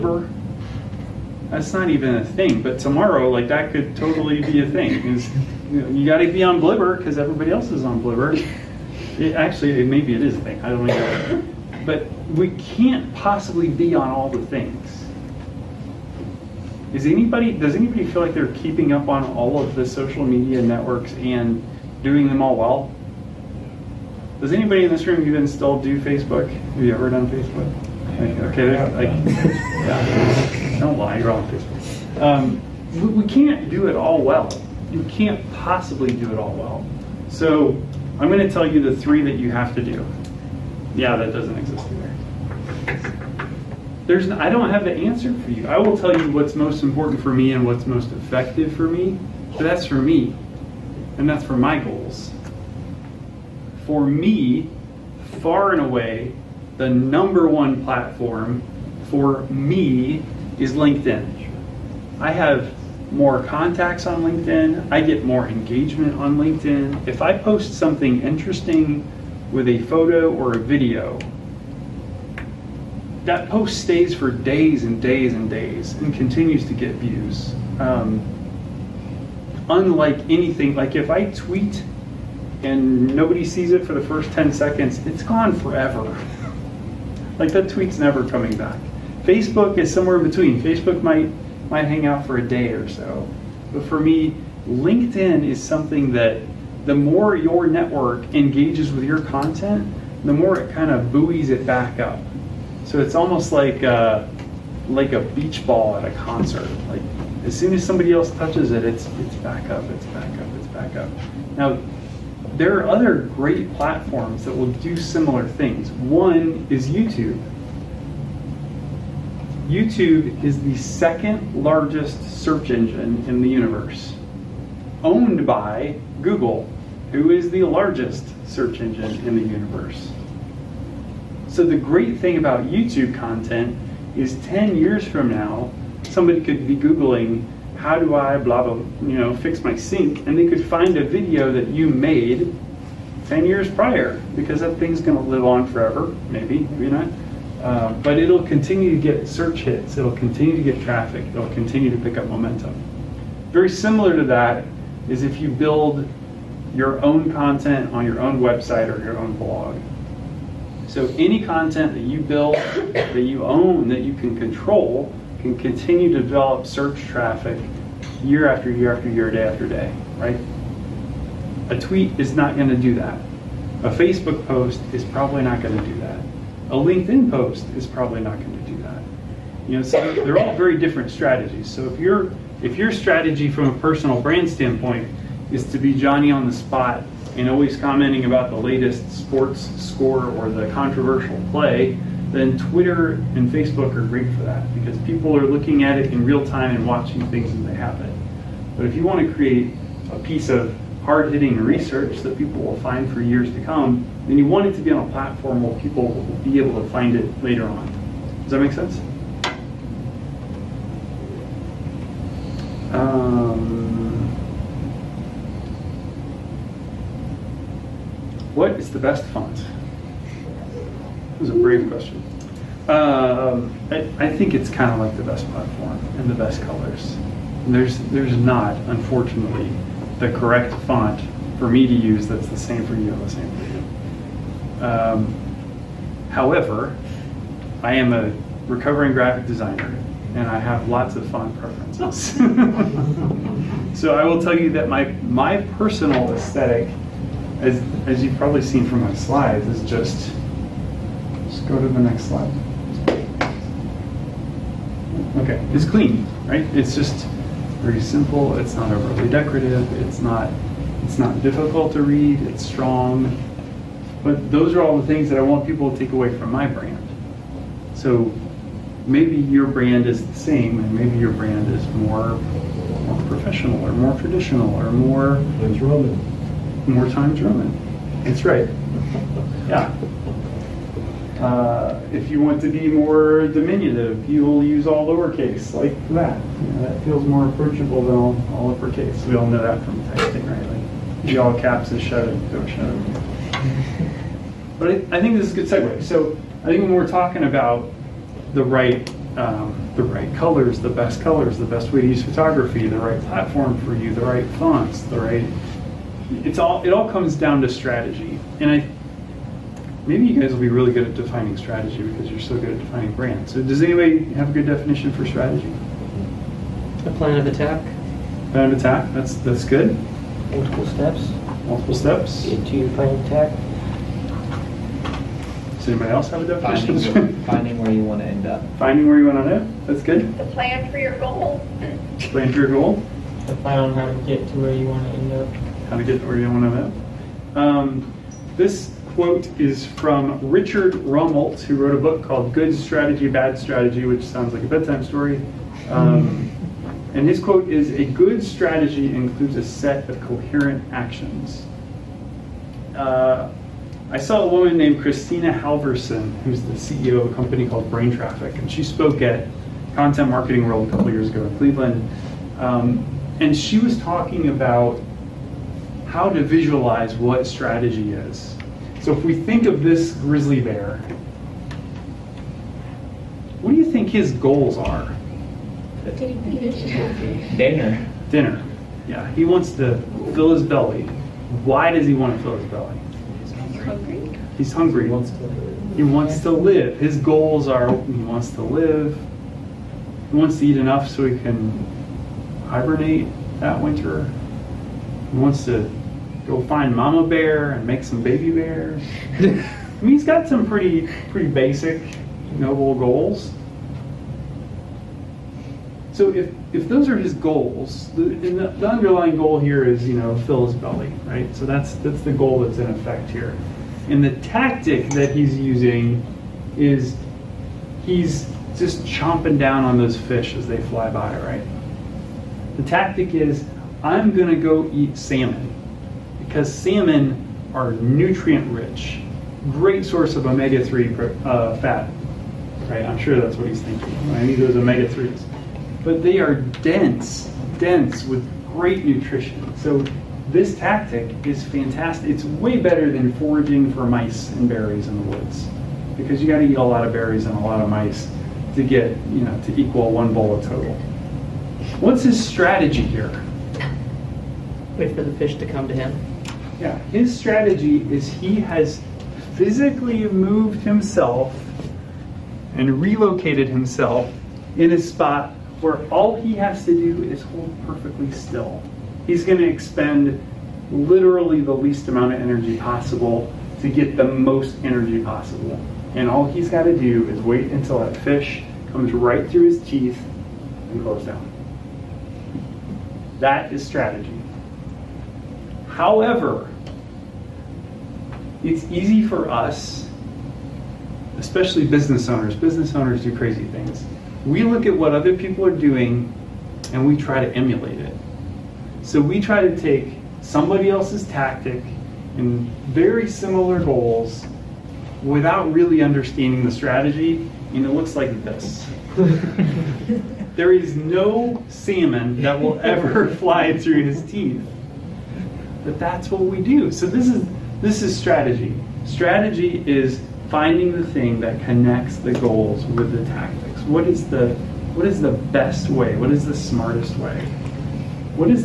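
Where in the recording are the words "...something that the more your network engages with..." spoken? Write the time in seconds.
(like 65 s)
95 s.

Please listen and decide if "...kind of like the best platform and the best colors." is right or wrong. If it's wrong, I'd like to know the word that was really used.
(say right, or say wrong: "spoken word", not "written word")
right.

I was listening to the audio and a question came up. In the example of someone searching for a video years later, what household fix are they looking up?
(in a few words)
Fix my sink.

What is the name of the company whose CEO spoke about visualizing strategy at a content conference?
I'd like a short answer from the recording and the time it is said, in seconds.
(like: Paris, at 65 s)
Brain Traffic, at 357 s.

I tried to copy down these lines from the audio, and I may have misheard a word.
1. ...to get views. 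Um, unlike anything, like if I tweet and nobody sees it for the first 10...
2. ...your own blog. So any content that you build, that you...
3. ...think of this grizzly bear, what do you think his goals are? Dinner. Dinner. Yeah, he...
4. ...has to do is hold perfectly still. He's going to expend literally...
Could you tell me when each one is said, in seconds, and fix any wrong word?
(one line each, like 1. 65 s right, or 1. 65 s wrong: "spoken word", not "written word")
1. 76 s right
2. 159 s right
3. 369 s right
4. 466 s right.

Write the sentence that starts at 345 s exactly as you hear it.
Um, and his quote is A good strategy includes a set of coherent actions.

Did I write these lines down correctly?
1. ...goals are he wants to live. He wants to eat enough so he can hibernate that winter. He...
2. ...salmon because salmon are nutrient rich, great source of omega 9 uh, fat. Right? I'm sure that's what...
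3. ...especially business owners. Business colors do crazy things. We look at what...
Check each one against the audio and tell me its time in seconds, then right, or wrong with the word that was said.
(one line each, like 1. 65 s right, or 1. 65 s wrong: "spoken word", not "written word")
1. 387 s right
2. 425 s wrong: "3", not "9"
3. 491 s wrong: "owners", not "colors".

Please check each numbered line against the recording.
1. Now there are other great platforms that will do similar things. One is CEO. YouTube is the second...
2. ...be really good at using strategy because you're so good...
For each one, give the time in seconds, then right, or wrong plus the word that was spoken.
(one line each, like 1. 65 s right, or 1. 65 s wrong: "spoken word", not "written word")
1. 111 s wrong: "YouTube", not "CEO"
2. 310 s wrong: "defining", not "using".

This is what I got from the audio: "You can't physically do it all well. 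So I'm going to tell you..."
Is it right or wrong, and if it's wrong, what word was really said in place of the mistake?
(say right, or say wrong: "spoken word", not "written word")
wrong: "possibly", not "physically".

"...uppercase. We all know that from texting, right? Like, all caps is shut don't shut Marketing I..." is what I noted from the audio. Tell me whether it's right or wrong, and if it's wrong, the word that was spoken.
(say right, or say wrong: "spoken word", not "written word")
wrong: "But", not "Marketing".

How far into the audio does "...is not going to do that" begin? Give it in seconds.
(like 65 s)
172 s.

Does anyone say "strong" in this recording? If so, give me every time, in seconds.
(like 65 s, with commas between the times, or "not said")
262 s.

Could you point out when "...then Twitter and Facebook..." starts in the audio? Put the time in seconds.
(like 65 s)
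192 s.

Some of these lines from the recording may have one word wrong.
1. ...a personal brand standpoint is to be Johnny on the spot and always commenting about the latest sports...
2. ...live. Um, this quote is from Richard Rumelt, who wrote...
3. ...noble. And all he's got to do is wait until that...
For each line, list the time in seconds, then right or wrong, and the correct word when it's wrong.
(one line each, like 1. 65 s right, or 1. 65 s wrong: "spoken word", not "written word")
1. 183 s right
2. 336 s right
3. 475 s wrong: "possible", not "noble".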